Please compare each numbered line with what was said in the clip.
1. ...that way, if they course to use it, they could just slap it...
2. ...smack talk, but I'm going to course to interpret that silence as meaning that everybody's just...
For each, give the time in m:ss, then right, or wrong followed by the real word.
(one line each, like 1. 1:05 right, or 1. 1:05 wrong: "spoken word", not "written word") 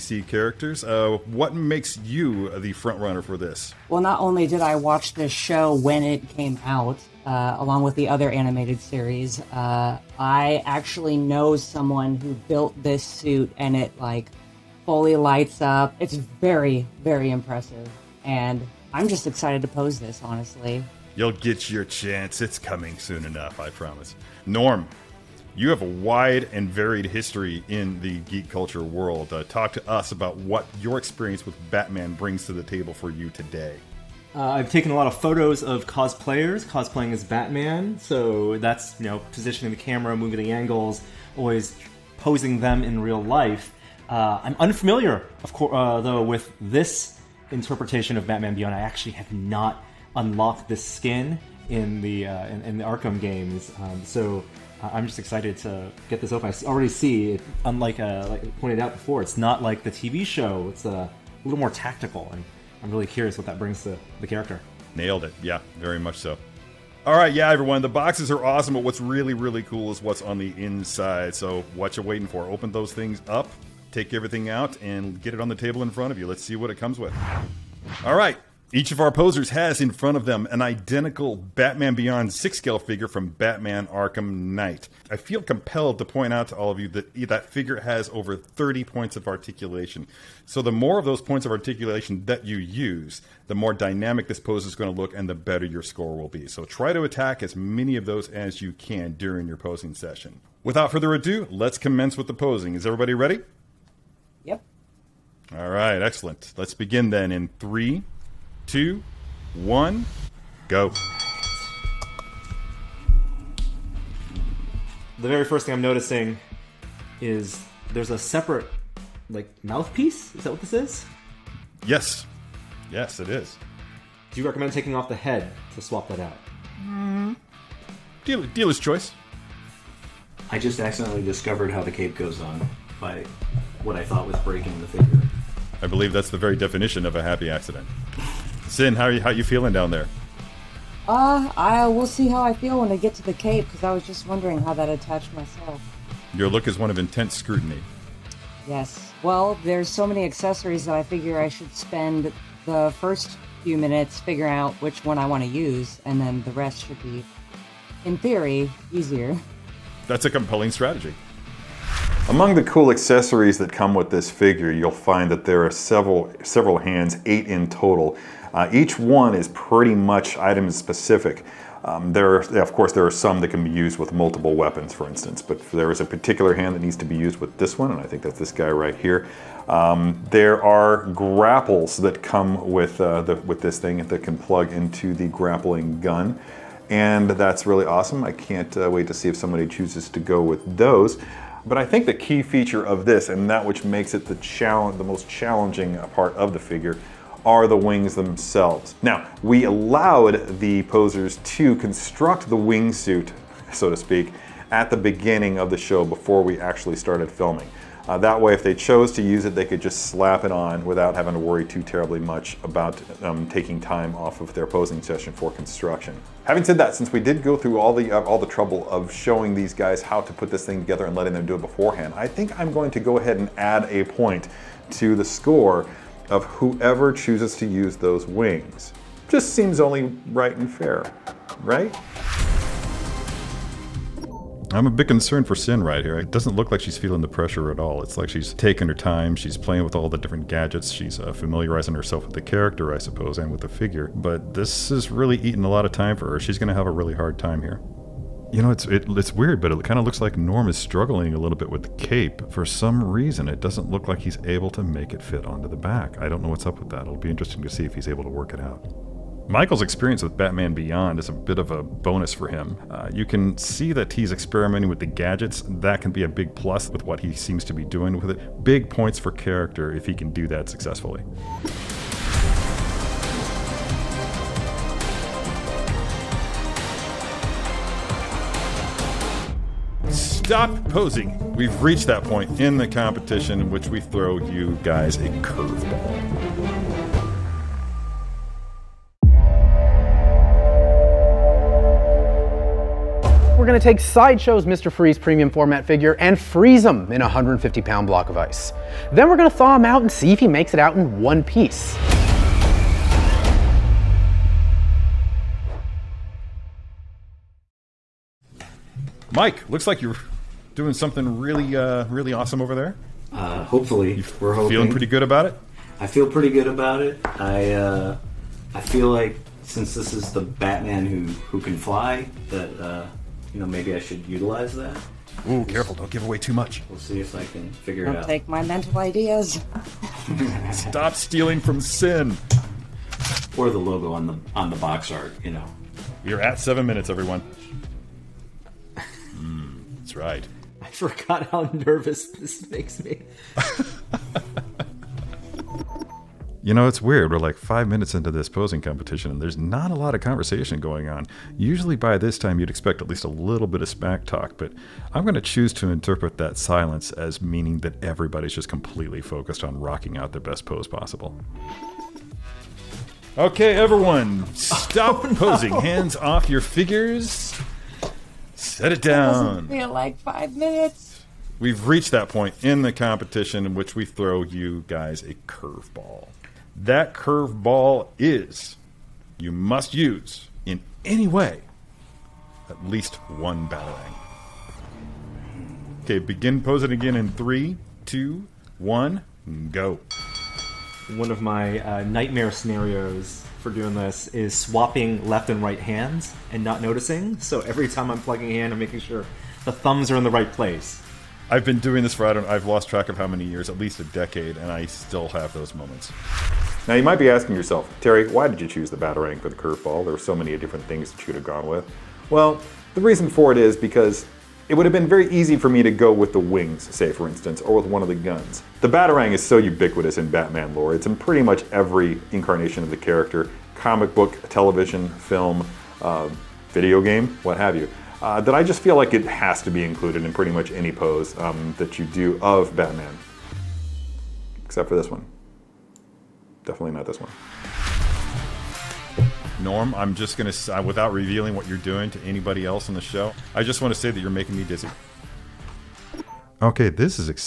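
1. 3:28 wrong: "chose", not "course"
2. 5:53 wrong: "choose", not "course".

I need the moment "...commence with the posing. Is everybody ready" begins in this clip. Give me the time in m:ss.
1:41.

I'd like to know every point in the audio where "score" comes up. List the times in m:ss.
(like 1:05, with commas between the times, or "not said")
1:35, 3:45.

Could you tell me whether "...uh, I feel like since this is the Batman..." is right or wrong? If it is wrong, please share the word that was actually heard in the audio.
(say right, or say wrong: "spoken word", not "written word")
right.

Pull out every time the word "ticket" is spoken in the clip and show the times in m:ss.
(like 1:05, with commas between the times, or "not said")
not said.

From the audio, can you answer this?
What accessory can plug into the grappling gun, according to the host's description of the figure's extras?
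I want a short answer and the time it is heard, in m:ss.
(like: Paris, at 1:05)
grapples, at 3:01.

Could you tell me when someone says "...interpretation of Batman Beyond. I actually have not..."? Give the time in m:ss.
0:47.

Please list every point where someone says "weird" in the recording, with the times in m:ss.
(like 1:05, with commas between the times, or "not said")
4:09, 5:47.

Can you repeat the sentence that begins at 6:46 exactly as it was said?
Now you might be asking yourself, Terry, why did you choose the Batarang for the curveball?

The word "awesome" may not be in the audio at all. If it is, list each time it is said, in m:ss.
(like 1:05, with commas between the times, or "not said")
1:08, 3:07, 5:12.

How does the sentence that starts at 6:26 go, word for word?
Okay, begin posing again in three, two, one, go.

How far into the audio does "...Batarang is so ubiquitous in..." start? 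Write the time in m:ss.
6:58.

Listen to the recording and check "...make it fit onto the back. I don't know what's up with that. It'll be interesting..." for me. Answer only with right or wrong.
right.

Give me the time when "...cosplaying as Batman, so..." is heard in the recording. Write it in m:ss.
0:36.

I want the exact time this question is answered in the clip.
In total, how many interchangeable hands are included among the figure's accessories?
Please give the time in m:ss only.
2:47.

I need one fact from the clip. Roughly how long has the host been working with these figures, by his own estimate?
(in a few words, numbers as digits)
at least a decade.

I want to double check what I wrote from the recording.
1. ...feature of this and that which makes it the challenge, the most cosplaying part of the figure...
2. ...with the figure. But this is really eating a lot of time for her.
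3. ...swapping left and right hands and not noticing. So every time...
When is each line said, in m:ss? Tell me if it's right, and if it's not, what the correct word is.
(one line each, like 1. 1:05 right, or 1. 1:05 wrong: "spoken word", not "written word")
1. 3:12 wrong: "challenging", not "cosplaying"
2. 4:03 right
3. 6:34 right.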